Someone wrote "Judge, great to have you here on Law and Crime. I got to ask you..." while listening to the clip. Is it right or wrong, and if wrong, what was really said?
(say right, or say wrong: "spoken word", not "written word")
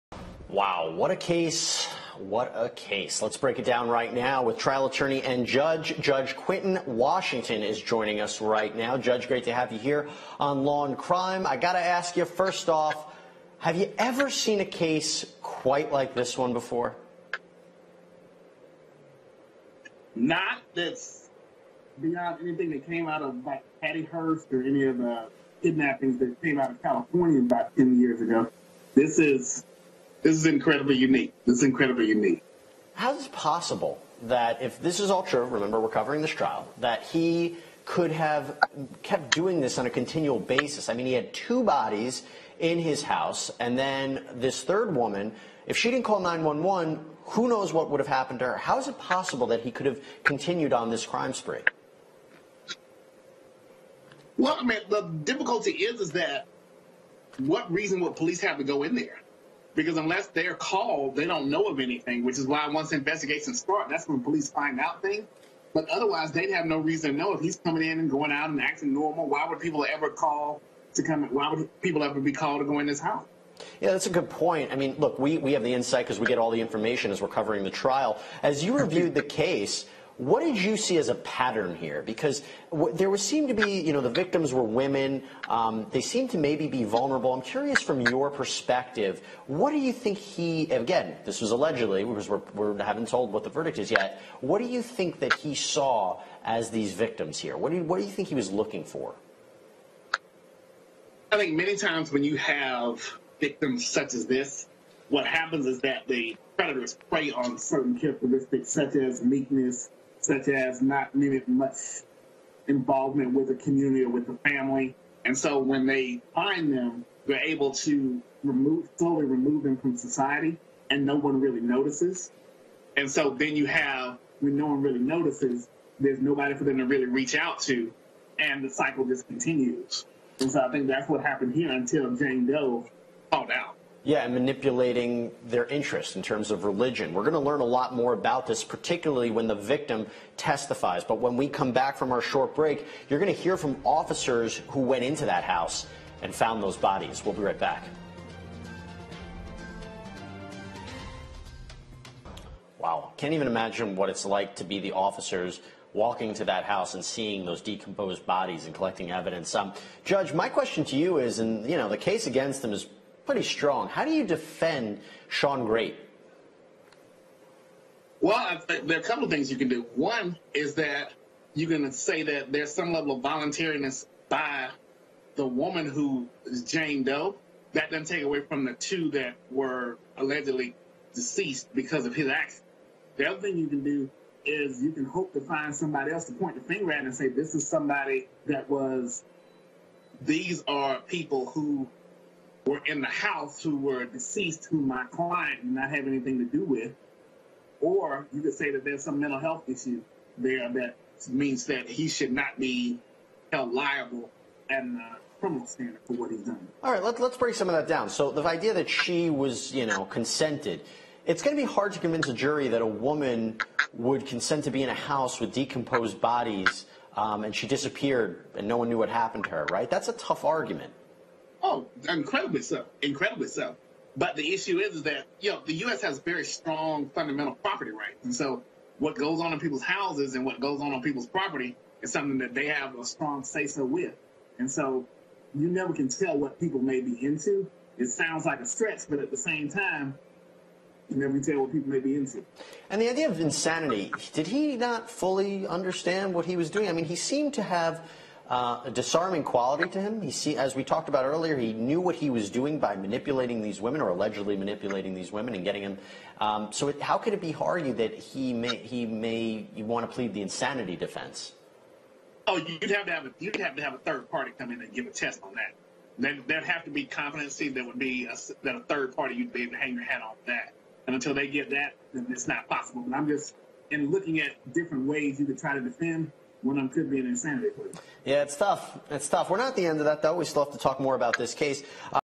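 right.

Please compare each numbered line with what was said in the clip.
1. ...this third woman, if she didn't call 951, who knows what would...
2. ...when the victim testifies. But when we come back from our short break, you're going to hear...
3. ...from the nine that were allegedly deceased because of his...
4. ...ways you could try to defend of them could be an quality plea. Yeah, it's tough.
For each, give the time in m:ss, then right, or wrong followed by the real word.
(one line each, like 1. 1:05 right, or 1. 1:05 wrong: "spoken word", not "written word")
1. 0:44 wrong: "911", not "951"
2. 2:19 right
3. 2:58 wrong: "two", not "nine"
4. 4:35 wrong: "insanity", not "quality".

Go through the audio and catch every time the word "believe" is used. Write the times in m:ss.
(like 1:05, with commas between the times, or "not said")
not said.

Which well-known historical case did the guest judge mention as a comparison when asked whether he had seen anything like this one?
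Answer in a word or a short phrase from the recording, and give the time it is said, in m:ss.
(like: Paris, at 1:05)
Patty Hearst, at 0:23.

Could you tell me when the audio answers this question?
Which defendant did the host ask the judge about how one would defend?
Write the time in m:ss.
2:45.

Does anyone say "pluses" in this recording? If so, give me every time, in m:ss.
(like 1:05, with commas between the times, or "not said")
not said.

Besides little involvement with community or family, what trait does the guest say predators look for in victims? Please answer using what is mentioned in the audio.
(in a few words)
Meekness.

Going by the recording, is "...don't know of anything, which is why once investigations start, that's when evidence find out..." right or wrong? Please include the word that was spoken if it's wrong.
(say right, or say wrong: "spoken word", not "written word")
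wrong: "police", not "evidence".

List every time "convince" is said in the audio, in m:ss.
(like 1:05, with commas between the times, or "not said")
3:31.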